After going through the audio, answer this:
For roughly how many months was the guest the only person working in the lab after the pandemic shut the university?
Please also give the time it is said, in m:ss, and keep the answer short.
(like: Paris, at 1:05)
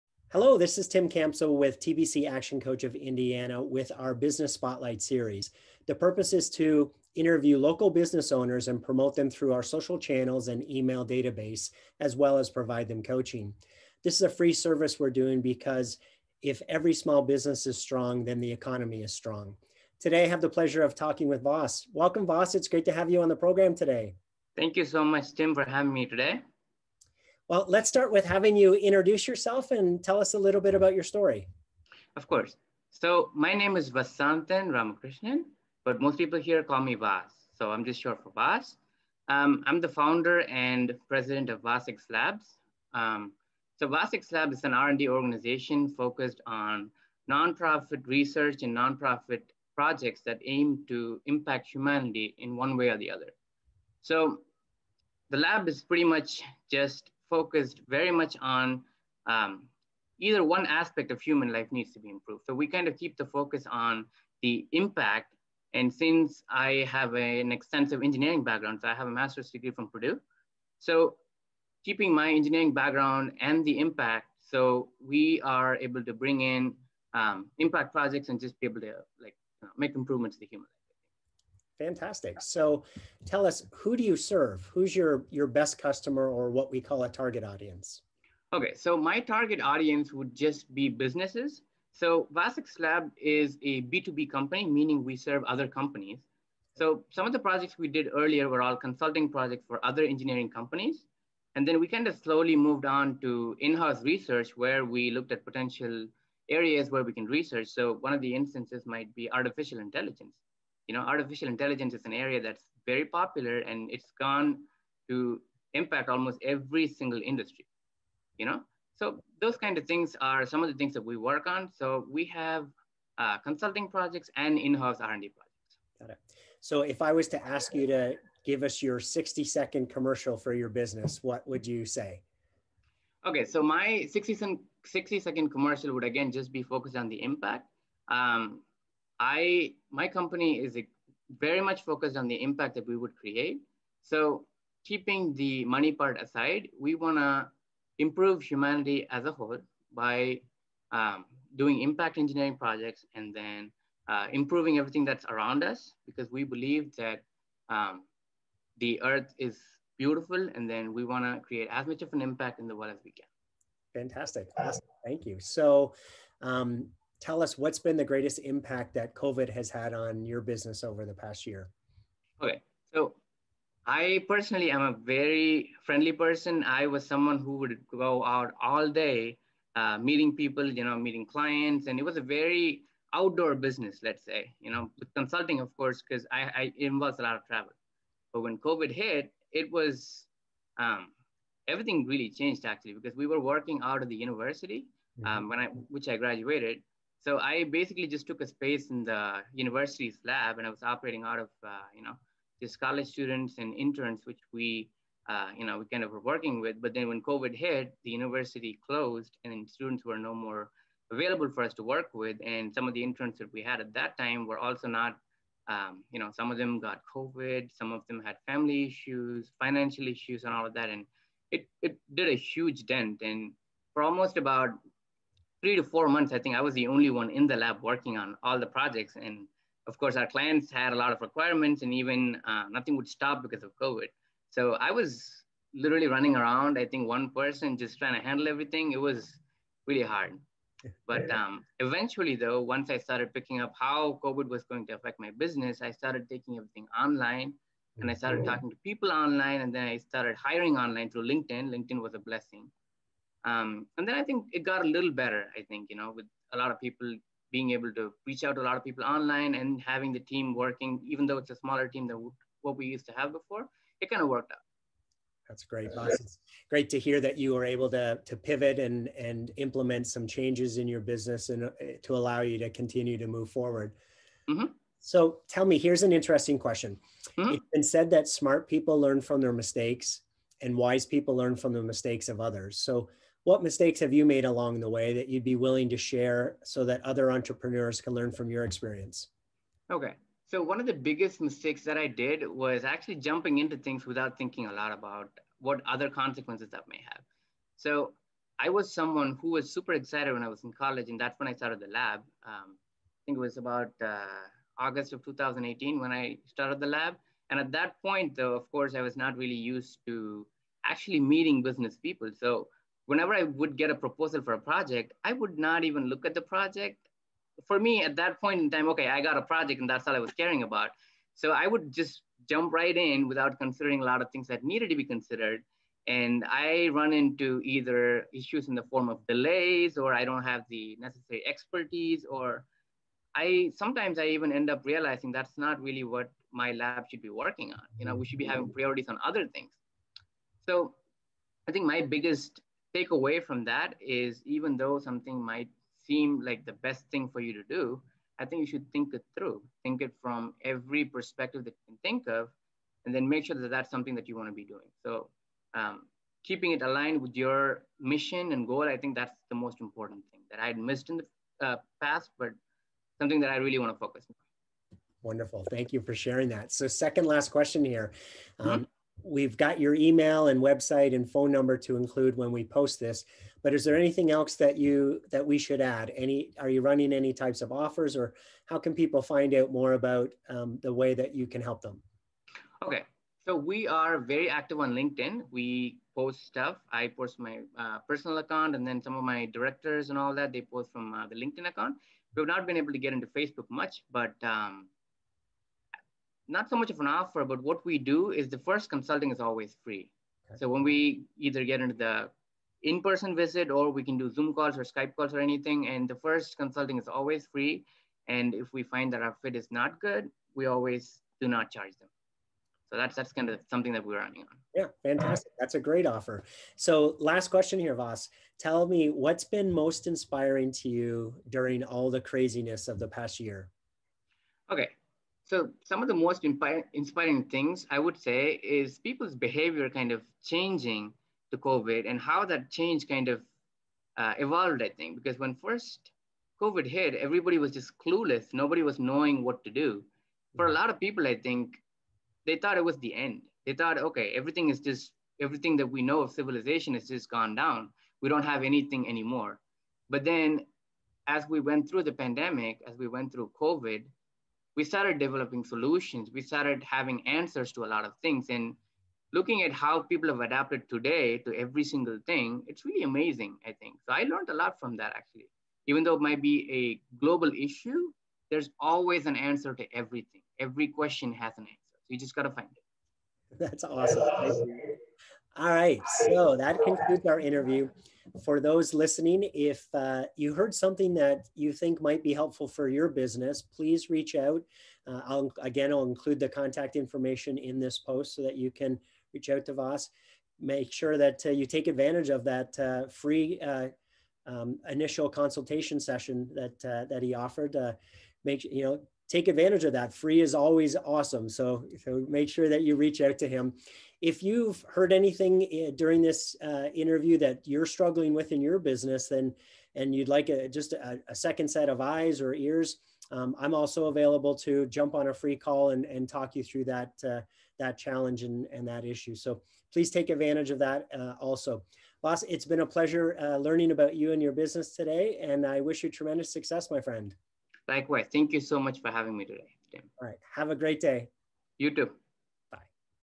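3 to 4 months, at 3:45.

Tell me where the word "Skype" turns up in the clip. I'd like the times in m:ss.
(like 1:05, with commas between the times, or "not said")
6:44.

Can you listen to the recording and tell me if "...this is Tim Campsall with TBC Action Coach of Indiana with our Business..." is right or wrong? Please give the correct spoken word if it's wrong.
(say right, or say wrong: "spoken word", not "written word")
right.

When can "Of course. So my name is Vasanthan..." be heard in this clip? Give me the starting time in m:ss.
0:32.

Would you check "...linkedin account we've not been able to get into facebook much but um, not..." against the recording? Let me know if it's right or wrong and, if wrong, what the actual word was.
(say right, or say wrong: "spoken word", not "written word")
right.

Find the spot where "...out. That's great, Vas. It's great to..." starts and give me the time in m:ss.
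4:24.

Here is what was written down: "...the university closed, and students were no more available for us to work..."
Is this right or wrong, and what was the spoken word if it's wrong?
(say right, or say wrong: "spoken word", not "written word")
right.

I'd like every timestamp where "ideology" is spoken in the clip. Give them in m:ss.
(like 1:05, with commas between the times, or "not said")
not said.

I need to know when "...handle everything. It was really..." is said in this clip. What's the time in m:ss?
3:58.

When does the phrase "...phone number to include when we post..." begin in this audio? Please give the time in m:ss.
6:11.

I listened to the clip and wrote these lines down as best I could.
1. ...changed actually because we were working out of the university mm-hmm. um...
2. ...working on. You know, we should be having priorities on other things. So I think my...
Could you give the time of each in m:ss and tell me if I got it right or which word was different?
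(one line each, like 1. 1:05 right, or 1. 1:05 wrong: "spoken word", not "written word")
1. 3:12 right
2. 5:37 right.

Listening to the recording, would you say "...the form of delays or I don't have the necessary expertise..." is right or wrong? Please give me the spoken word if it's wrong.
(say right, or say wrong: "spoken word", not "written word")
right.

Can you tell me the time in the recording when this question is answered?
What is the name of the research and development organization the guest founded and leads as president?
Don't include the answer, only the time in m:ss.
0:41.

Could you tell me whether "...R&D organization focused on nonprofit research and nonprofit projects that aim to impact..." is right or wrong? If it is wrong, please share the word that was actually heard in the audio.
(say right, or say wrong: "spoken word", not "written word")
right.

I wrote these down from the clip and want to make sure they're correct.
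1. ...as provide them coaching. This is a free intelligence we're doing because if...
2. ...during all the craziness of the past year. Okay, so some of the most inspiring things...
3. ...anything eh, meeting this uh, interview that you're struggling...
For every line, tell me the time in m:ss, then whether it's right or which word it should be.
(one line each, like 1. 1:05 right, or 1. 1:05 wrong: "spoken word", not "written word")
1. 0:12 wrong: "service", not "intelligence"
2. 7:01 right
3. 8:25 wrong: "during", not "meeting".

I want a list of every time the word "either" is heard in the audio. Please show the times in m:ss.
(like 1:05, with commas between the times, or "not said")
1:00, 5:27, 6:41.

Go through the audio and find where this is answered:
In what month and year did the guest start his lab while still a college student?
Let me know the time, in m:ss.
5:04.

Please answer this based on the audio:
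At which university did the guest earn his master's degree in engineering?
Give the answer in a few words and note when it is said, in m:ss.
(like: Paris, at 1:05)
Purdue, at 1:09.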